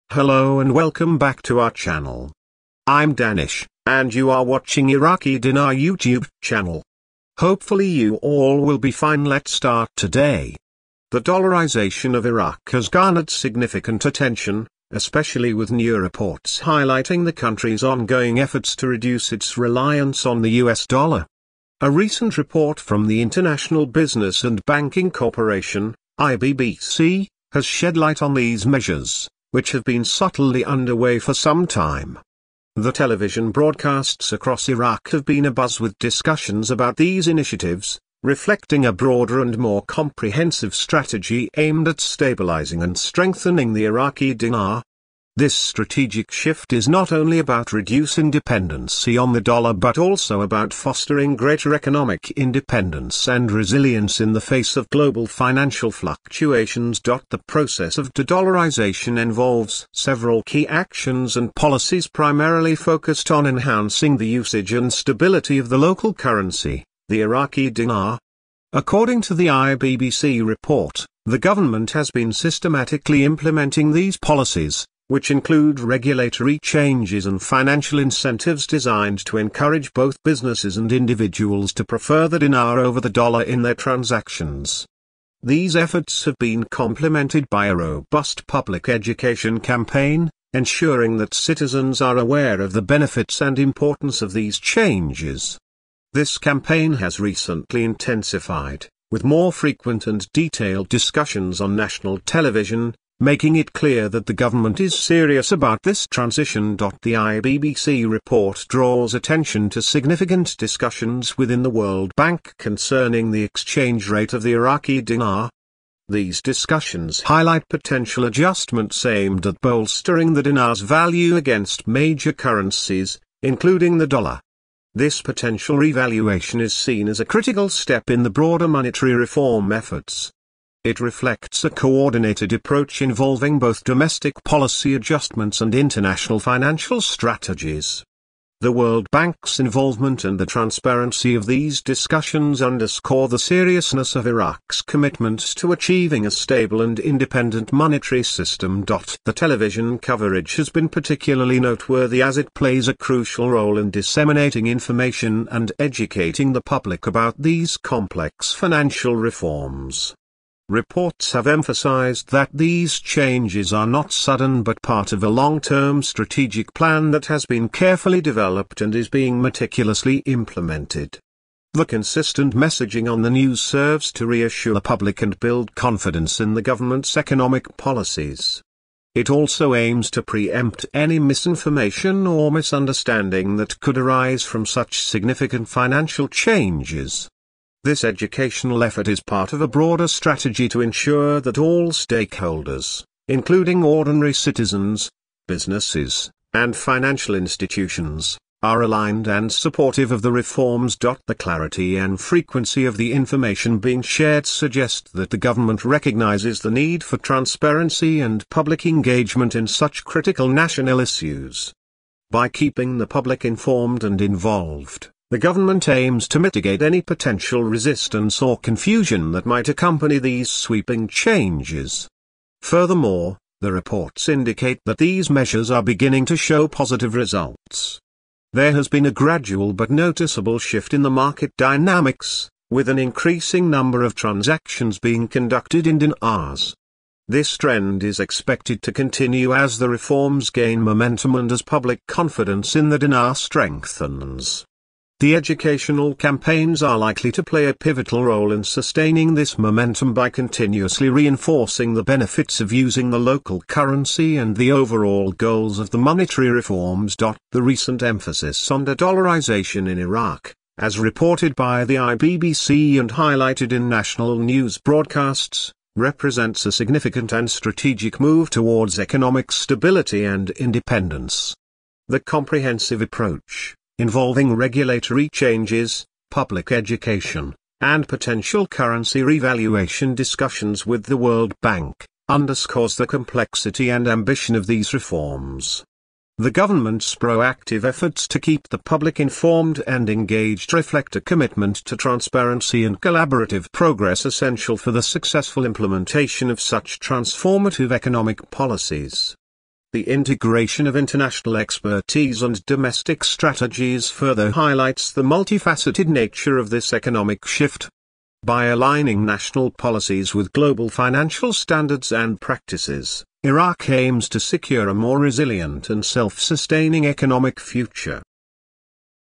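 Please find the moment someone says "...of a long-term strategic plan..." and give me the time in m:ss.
2:45.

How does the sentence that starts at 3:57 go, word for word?
This trend is expected to continue as the reforms gain momentum and as public confidence in the dinar strengthens.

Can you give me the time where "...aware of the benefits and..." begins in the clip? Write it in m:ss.
1:32.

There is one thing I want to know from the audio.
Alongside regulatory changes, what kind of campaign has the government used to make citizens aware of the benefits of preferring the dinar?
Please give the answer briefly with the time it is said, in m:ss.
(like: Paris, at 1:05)
public education campaign, at 1:28.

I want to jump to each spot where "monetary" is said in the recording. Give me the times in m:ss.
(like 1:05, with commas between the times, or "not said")
2:08, 2:27, 4:15.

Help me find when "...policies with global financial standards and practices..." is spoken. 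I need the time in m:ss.
5:09.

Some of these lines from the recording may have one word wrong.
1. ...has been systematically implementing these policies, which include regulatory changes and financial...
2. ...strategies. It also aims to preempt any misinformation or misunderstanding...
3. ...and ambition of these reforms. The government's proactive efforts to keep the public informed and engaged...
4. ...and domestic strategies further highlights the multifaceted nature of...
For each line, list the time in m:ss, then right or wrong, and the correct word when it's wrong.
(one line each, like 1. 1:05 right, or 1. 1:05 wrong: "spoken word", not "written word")
1. 1:11 right
2. 2:57 wrong: "policies", not "strategies"
3. 4:43 right
4. 5:02 right.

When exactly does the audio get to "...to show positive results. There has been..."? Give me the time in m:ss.
3:46.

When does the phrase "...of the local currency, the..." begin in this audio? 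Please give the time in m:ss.
1:05.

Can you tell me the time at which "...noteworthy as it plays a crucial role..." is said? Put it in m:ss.
2:31.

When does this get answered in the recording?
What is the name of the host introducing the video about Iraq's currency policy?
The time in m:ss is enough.
0:03.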